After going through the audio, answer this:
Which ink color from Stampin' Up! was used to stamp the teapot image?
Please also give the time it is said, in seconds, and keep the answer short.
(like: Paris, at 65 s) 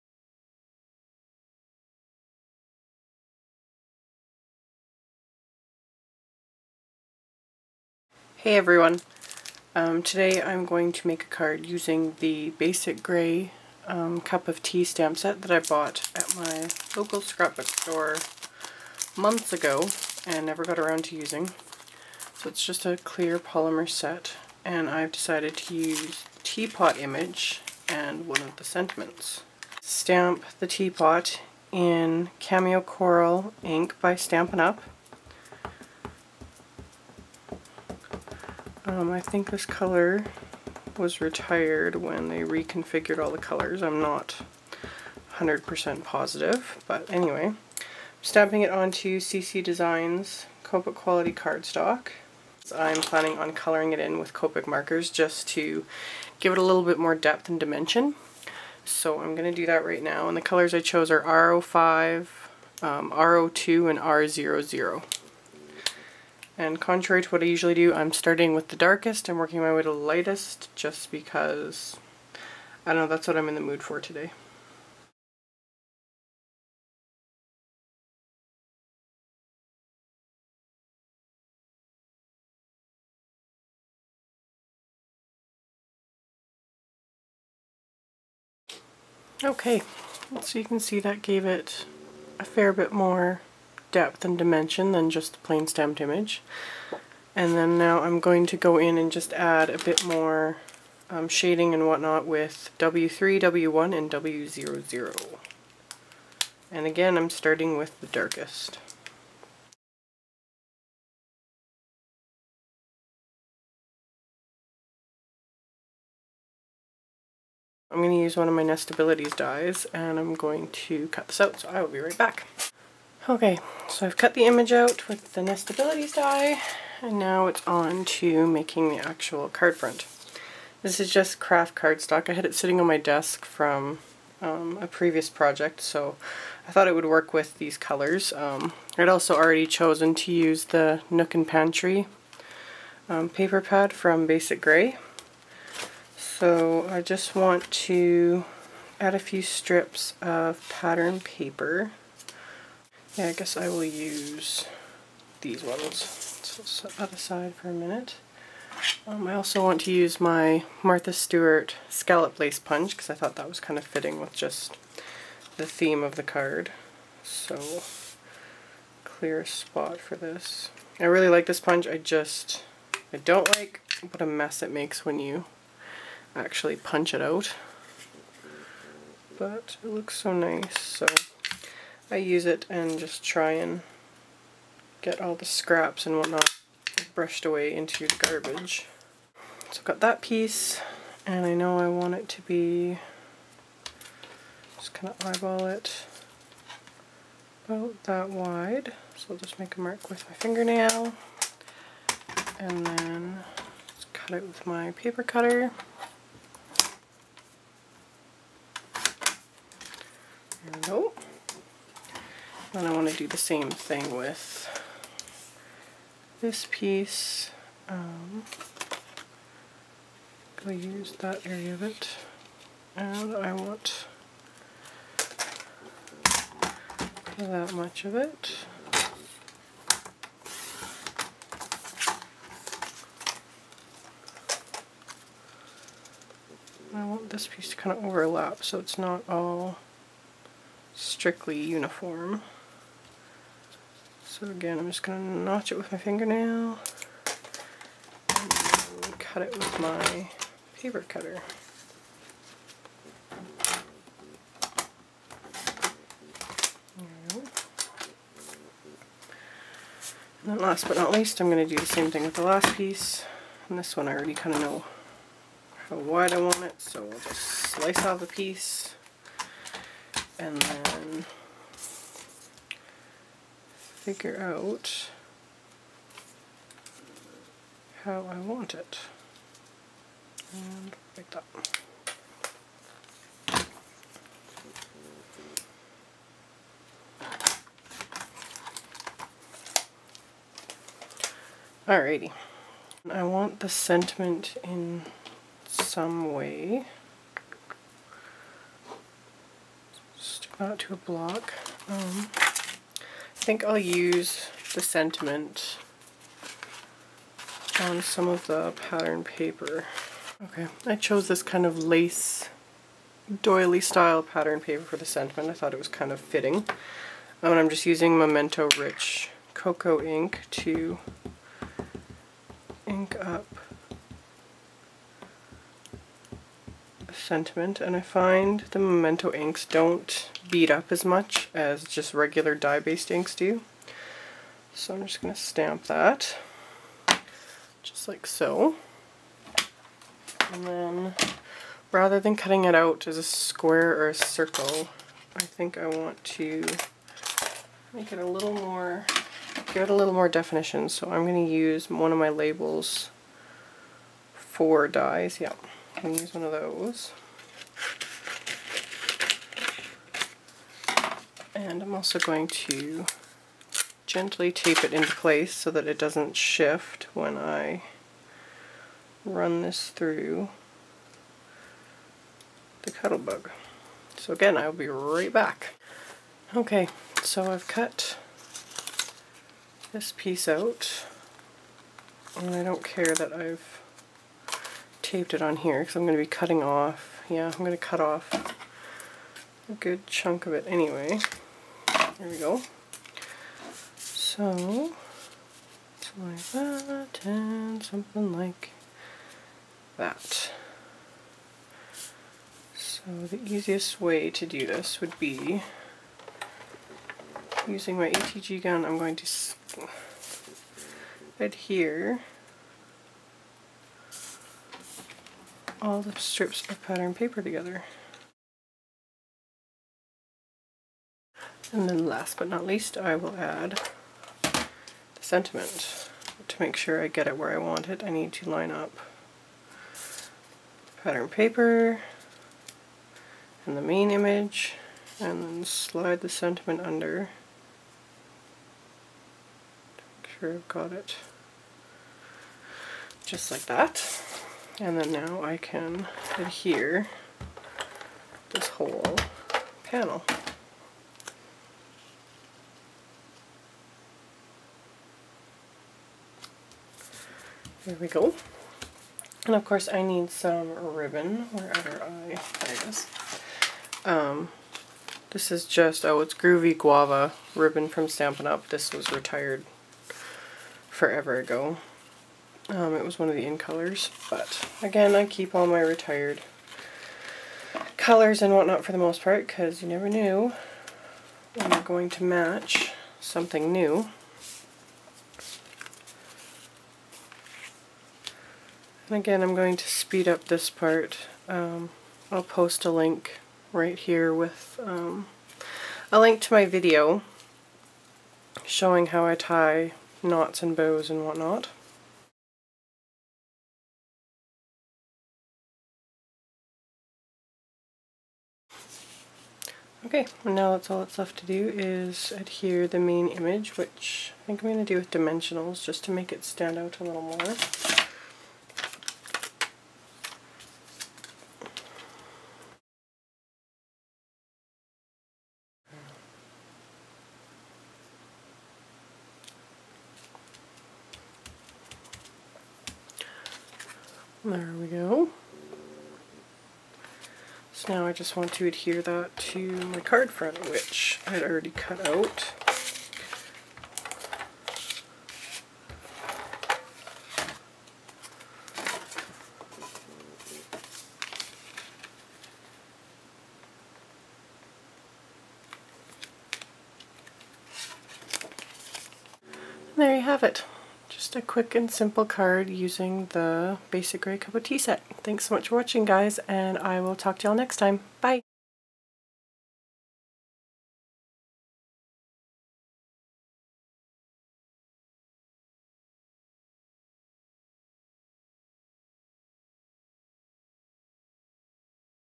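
Cameo Coral, at 32 s.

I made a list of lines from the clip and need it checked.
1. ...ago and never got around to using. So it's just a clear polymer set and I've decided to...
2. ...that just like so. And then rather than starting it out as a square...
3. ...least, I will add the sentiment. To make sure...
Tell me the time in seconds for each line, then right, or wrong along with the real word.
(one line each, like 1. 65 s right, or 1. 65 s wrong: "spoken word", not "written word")
1. 19 s right
2. 335 s wrong: "cutting", not "starting"
3. 422 s right.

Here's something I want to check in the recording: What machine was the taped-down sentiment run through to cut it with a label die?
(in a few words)
Cuttlebug.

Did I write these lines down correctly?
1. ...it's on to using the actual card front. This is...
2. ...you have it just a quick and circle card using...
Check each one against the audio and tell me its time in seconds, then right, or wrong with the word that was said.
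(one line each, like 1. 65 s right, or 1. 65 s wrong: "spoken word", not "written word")
1. 127 s wrong: "making", not "using"
2. 560 s wrong: "simple", not "circle".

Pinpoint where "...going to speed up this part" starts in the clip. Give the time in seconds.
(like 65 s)
489 s.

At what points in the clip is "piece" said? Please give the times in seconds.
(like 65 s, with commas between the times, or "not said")
190 s, 216 s, 237 s, 262 s, 268 s, 380 s.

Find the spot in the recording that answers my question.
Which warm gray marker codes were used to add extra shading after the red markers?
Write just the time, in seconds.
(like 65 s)
102 s.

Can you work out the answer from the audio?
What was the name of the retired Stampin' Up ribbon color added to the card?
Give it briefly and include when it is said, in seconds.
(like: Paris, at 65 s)
Groovy Guava, at 466 s.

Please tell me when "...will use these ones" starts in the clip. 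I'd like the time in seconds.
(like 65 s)
153 s.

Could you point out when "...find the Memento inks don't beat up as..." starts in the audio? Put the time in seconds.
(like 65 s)
328 s.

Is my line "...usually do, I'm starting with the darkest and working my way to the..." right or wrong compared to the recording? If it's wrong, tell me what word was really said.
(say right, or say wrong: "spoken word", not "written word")
right.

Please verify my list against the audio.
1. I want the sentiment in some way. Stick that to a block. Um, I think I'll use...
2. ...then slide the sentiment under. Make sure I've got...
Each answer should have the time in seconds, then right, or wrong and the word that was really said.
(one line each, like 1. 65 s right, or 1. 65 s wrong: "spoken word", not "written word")
1. 293 s right
2. 435 s right.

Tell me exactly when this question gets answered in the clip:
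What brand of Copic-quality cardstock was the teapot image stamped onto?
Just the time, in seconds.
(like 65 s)
49 s.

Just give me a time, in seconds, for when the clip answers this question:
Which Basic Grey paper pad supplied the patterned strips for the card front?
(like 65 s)
141 s.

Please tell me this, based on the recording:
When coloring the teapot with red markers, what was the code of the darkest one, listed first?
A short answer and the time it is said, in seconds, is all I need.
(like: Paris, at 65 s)
R05, at 61 s.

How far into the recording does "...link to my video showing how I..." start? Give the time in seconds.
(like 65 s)
496 s.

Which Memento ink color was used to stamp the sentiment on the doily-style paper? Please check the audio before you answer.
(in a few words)
Rich Cocoa.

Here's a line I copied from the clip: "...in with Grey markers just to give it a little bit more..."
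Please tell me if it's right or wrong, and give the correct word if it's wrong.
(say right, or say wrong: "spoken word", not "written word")
wrong: "Copic", not "Grey".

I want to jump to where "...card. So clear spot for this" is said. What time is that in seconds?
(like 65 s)
166 s.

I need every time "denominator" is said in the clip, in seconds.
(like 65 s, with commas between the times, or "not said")
not said.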